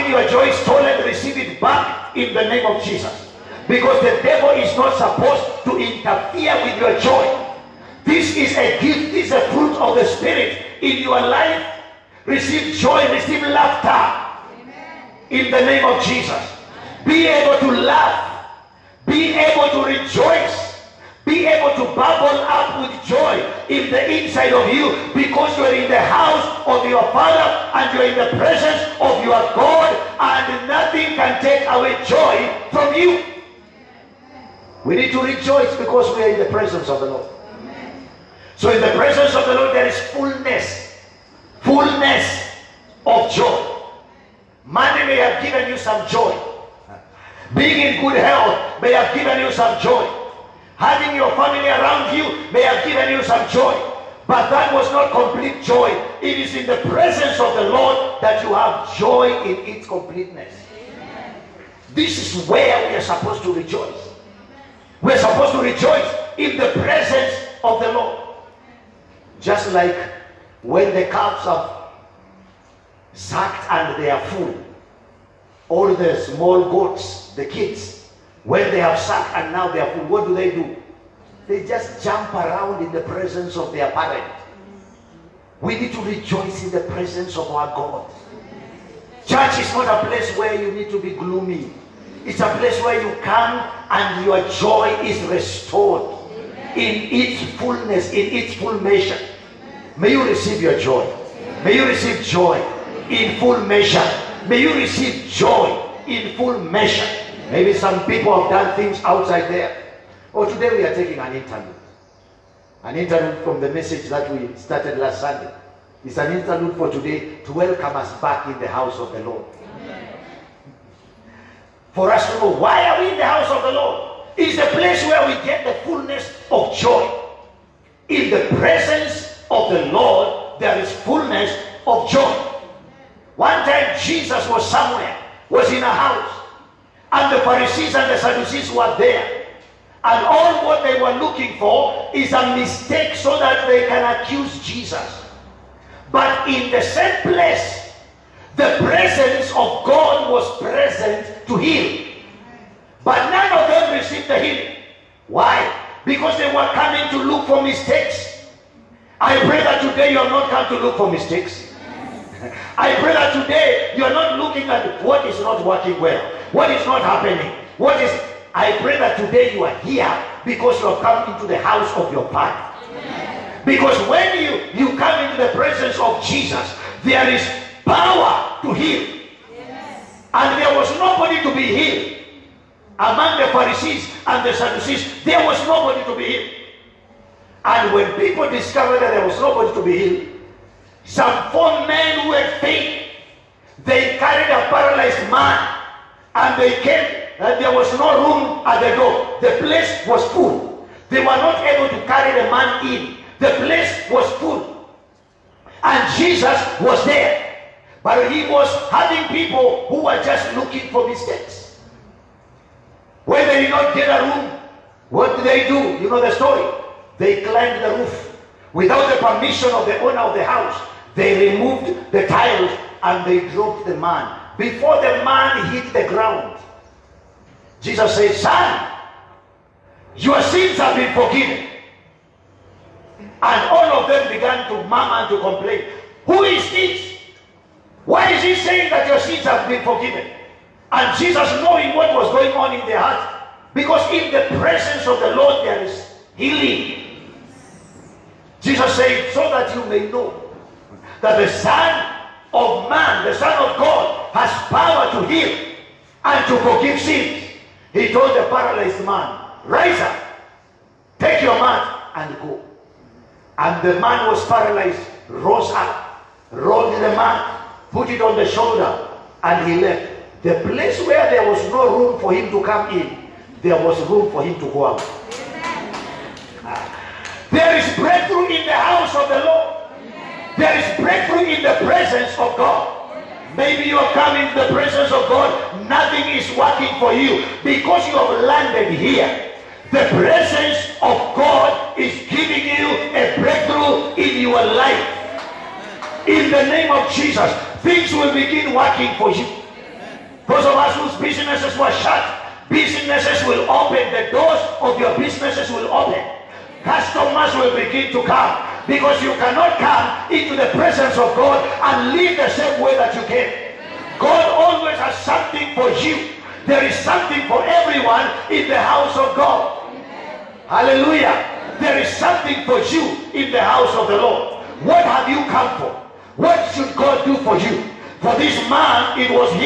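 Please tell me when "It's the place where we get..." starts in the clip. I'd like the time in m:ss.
2:04.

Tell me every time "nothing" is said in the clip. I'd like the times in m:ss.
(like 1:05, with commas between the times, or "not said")
0:30, 4:45.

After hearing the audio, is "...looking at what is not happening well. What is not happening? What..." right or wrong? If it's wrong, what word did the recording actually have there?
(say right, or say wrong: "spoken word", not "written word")
wrong: "working", not "happening".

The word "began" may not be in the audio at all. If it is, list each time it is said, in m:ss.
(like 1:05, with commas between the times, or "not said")
3:54.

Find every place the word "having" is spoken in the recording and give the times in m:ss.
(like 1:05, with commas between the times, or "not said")
0:50, 3:28.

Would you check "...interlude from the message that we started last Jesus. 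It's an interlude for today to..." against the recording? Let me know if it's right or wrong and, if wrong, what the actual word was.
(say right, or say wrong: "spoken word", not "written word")
wrong: "Sunday", not "Jesus".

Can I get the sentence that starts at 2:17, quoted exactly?
And the Pharisees and the Sadducees were there.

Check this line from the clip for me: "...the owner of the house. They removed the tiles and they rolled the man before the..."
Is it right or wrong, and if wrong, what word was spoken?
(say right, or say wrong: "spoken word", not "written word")
wrong: "dropped", not "rolled".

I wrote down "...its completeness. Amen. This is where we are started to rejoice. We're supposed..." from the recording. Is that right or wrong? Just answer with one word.
wrong.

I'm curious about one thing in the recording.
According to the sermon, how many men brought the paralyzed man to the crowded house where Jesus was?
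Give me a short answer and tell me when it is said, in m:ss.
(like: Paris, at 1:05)
4, at 3:11.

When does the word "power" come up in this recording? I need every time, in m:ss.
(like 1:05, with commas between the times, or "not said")
2:57, 4:14.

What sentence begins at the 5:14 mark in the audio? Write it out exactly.
God always has something for you.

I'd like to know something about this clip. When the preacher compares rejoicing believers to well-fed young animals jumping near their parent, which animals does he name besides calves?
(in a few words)
goats.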